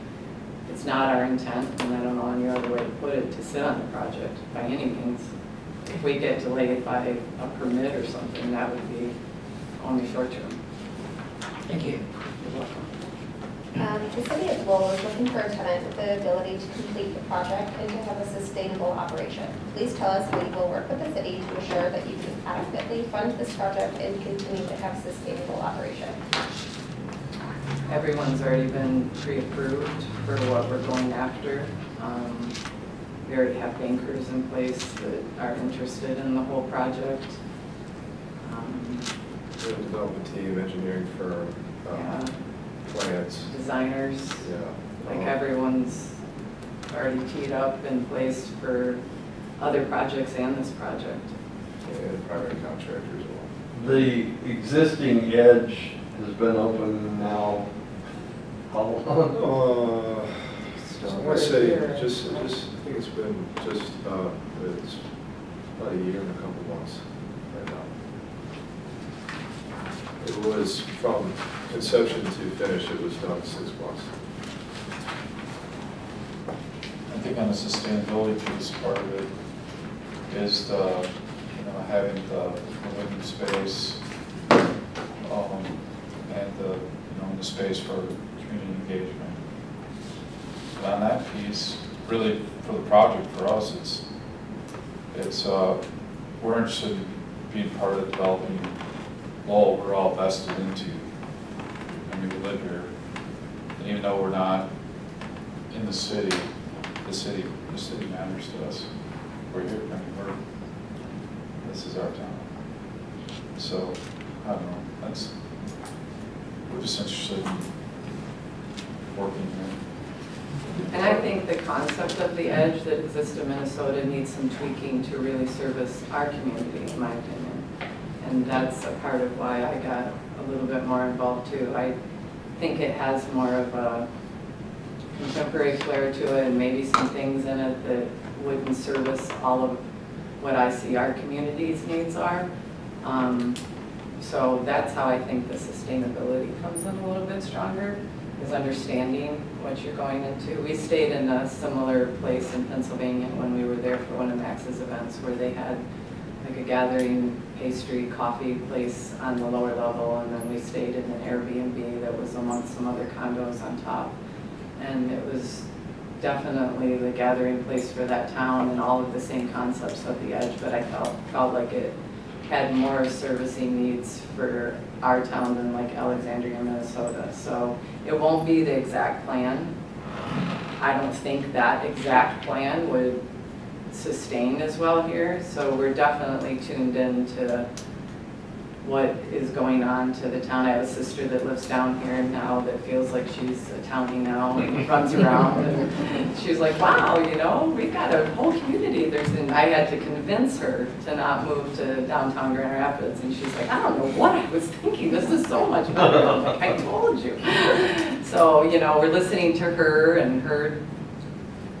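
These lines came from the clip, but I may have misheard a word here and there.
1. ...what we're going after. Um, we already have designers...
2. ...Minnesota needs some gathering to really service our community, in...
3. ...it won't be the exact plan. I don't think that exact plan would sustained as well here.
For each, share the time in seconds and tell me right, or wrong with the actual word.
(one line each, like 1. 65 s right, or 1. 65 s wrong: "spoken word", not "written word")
1. 30 s wrong: "bankers", not "designers"
2. 123 s wrong: "tweaking", not "gathering"
3. 178 s right.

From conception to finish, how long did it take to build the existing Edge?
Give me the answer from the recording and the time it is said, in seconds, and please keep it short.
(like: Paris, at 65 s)
six months, at 73 s.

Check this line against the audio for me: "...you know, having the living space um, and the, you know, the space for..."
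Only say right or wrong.
right.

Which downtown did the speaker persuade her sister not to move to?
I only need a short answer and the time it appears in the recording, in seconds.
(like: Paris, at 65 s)
Grand Rapids, at 202 s.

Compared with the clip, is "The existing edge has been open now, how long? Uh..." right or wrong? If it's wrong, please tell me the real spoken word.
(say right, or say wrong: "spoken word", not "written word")
right.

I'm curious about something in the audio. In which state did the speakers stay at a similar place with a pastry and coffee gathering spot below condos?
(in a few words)
Pennsylvania.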